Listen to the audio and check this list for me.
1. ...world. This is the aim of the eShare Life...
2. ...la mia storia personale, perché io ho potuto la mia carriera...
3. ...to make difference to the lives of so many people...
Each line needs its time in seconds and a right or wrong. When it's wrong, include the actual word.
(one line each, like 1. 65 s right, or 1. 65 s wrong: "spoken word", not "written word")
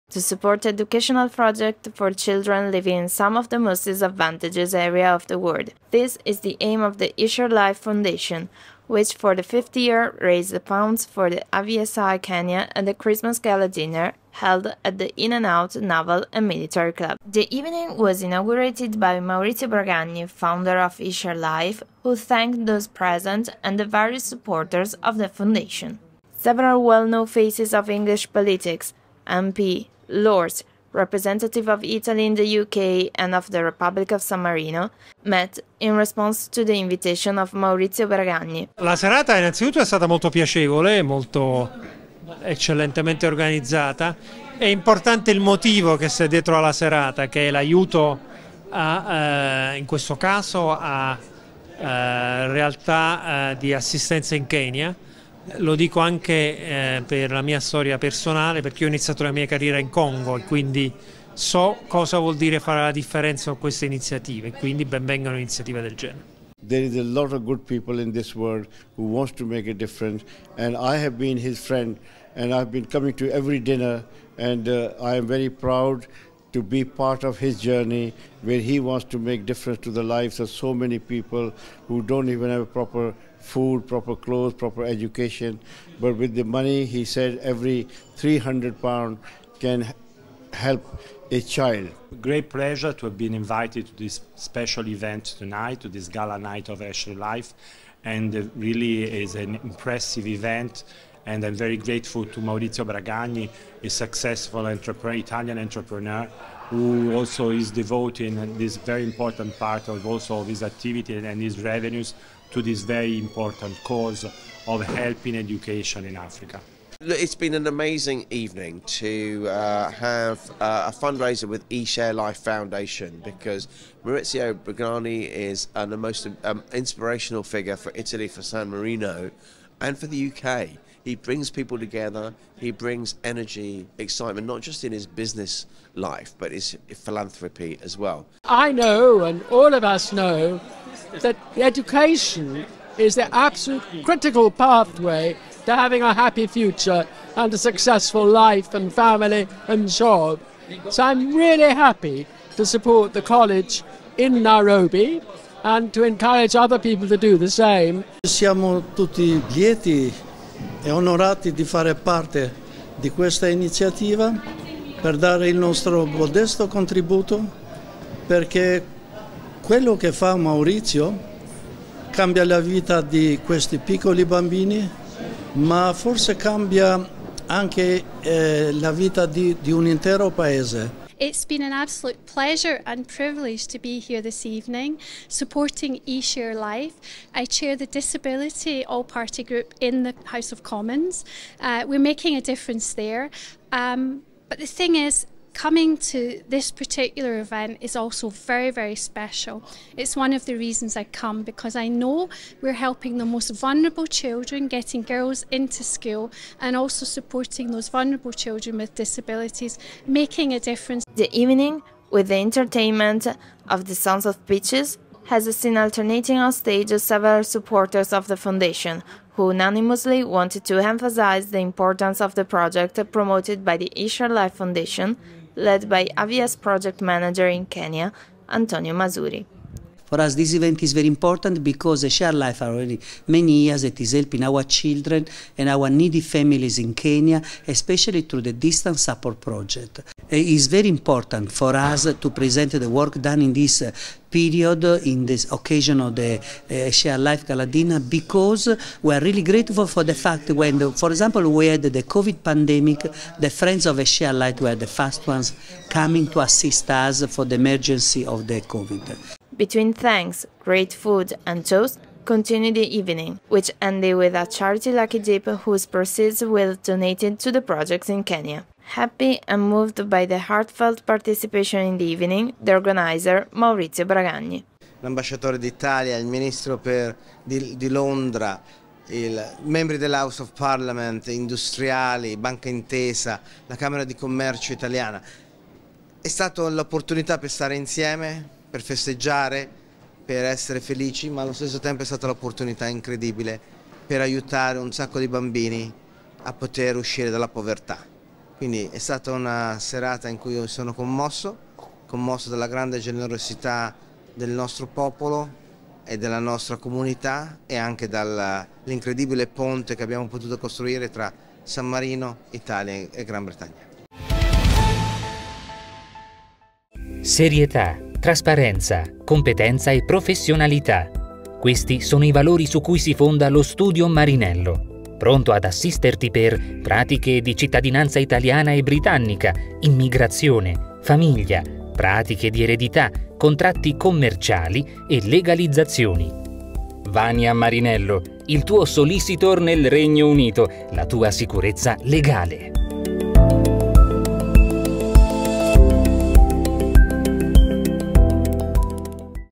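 1. 5 s right
2. 57 s wrong: "iniziato", not "potuto"
3. 79 s right.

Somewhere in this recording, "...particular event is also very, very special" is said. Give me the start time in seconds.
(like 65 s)
196 s.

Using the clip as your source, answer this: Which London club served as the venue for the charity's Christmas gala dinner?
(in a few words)
In and Out Naval and Military Club.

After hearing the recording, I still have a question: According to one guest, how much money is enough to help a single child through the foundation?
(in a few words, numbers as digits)
£300.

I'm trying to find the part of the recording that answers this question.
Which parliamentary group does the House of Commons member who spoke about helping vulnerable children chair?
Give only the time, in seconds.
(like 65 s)
187 s.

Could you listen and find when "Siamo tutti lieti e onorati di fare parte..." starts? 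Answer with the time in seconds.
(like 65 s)
158 s.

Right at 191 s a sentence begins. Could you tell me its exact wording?
Uh, we're making a difference there.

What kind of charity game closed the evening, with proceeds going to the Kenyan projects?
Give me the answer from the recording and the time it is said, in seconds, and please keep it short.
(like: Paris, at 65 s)
lucky dip, at 264 s.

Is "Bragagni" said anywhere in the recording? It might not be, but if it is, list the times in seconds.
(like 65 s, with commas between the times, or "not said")
19 s, 102 s, 124 s, 274 s.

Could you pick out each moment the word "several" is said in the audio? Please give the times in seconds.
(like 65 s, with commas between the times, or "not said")
26 s, 216 s.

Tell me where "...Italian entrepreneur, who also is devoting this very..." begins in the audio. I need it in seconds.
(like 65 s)
104 s.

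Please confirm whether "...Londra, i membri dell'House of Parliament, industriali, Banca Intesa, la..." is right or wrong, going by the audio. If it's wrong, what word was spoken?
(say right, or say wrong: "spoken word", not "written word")
right.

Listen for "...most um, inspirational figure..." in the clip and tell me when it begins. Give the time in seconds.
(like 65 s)
125 s.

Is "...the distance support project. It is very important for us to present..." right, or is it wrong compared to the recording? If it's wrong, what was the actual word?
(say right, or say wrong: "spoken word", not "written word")
right.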